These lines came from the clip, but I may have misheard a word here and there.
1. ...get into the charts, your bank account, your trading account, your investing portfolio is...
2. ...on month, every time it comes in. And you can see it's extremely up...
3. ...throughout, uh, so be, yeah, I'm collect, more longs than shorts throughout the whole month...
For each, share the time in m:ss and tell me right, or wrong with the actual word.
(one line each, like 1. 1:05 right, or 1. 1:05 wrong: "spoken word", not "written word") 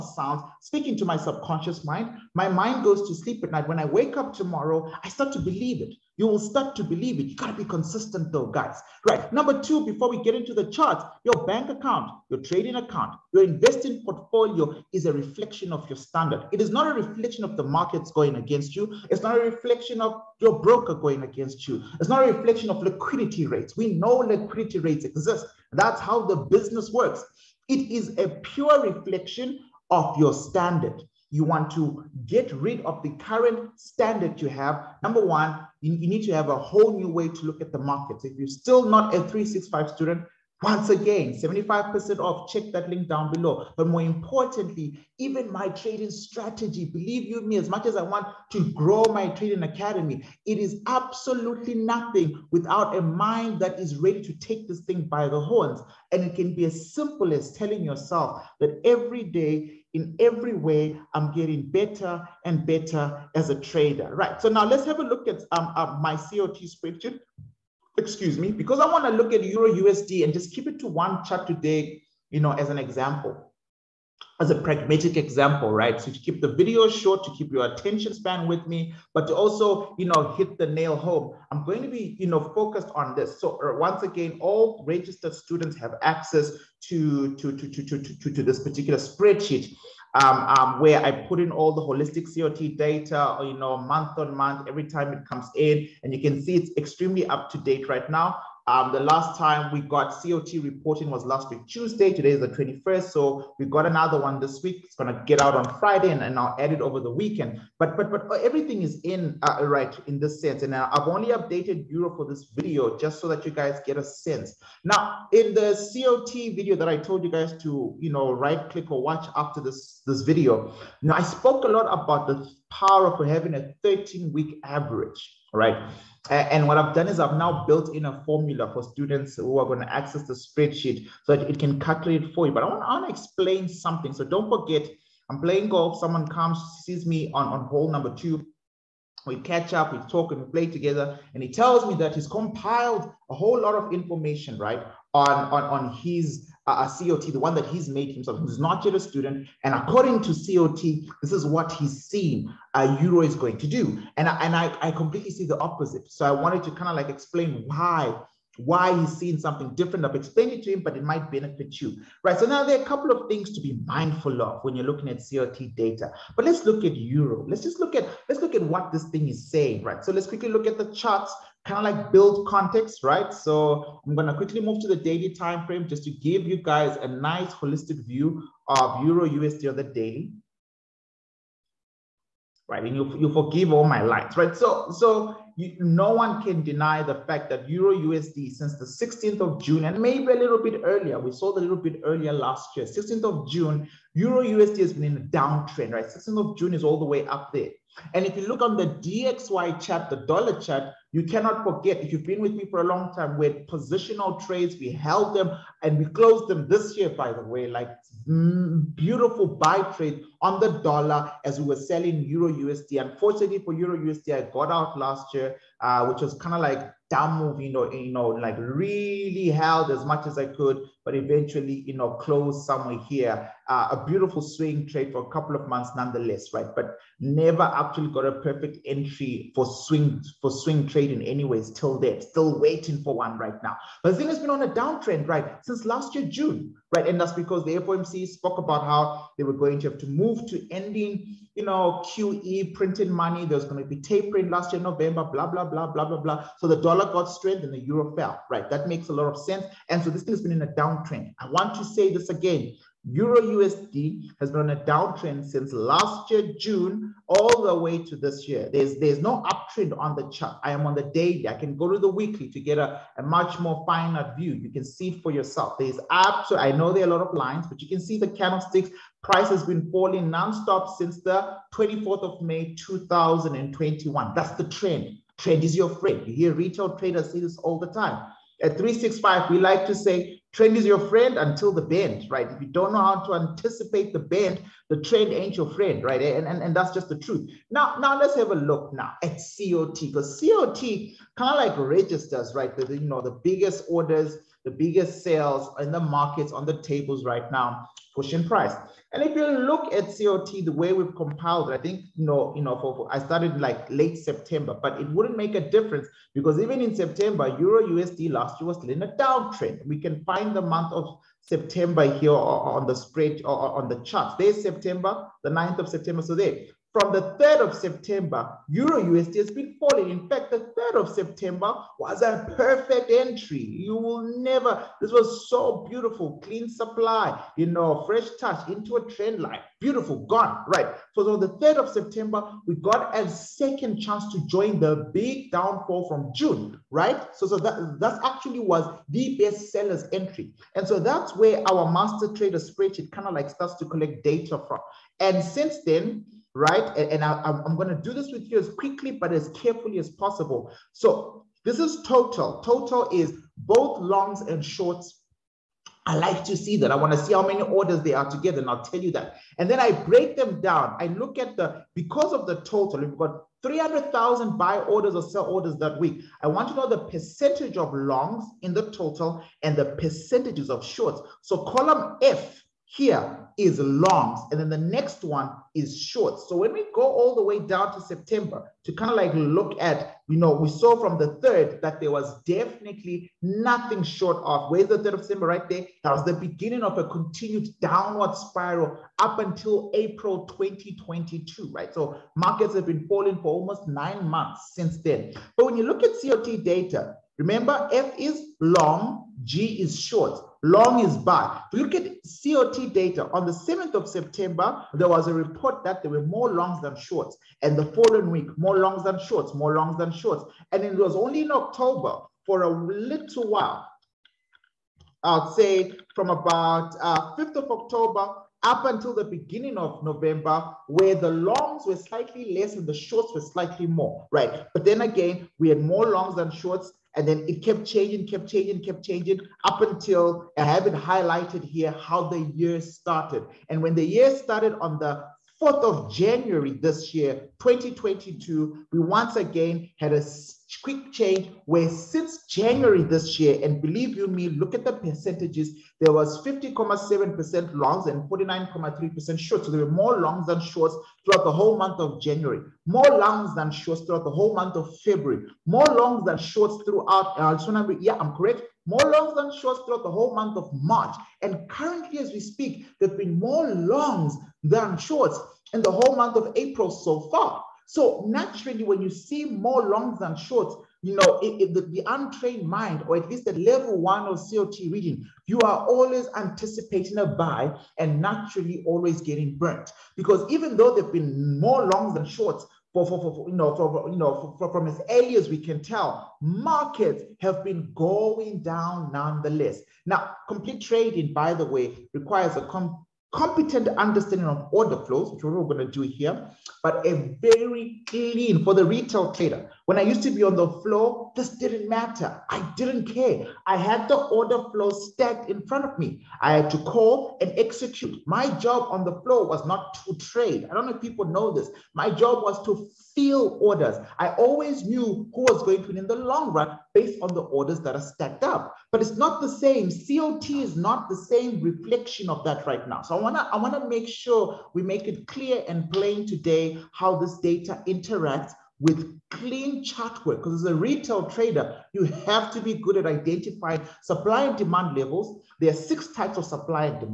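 1. 0:10 right
2. 1:34 right
3. 7:36 wrong: "correct", not "collect".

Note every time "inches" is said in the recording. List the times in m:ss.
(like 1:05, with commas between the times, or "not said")
not said.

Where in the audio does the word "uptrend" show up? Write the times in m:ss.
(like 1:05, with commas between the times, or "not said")
4:19.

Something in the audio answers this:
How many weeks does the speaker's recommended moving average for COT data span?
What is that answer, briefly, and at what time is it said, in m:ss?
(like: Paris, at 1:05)
13, at 2:03.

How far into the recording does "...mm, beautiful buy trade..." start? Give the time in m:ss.
3:28.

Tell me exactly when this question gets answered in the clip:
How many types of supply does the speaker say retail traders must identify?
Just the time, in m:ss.
8:55.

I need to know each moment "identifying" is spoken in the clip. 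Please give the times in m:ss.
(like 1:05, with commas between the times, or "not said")
8:53.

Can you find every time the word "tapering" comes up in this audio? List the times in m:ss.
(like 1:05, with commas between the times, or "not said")
4:04.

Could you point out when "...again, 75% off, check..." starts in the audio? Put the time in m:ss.
0:40.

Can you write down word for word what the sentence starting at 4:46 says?
And, and, and that's just the truth.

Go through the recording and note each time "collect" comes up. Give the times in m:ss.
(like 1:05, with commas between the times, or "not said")
5:43.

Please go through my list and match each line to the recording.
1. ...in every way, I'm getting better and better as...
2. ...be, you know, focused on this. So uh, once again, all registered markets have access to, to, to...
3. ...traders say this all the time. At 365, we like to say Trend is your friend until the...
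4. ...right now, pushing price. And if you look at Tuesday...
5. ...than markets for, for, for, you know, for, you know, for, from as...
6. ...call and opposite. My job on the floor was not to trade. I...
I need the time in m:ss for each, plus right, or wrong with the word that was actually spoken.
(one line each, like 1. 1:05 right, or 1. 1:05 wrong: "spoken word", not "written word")
1. 0:59 right
2. 1:21 wrong: "students", not "markets"
3. 4:36 right
4. 4:57 wrong: "COT", not "Tuesday"
5. 8:02 wrong: "shorts", not "markets"
6. 8:26 wrong: "execute", not "opposite".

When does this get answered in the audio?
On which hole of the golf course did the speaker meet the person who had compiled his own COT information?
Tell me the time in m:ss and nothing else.
2:17.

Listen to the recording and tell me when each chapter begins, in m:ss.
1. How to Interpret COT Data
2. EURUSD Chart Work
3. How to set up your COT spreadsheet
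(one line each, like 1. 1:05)
1. 5:45
2. 2:50
3. 1:10.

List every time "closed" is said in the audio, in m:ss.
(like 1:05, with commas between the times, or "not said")
3:26, 3:42.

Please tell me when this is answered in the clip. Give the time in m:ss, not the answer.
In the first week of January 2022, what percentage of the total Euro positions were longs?
7:26.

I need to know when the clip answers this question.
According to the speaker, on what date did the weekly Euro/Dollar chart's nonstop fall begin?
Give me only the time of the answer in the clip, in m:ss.
4:31.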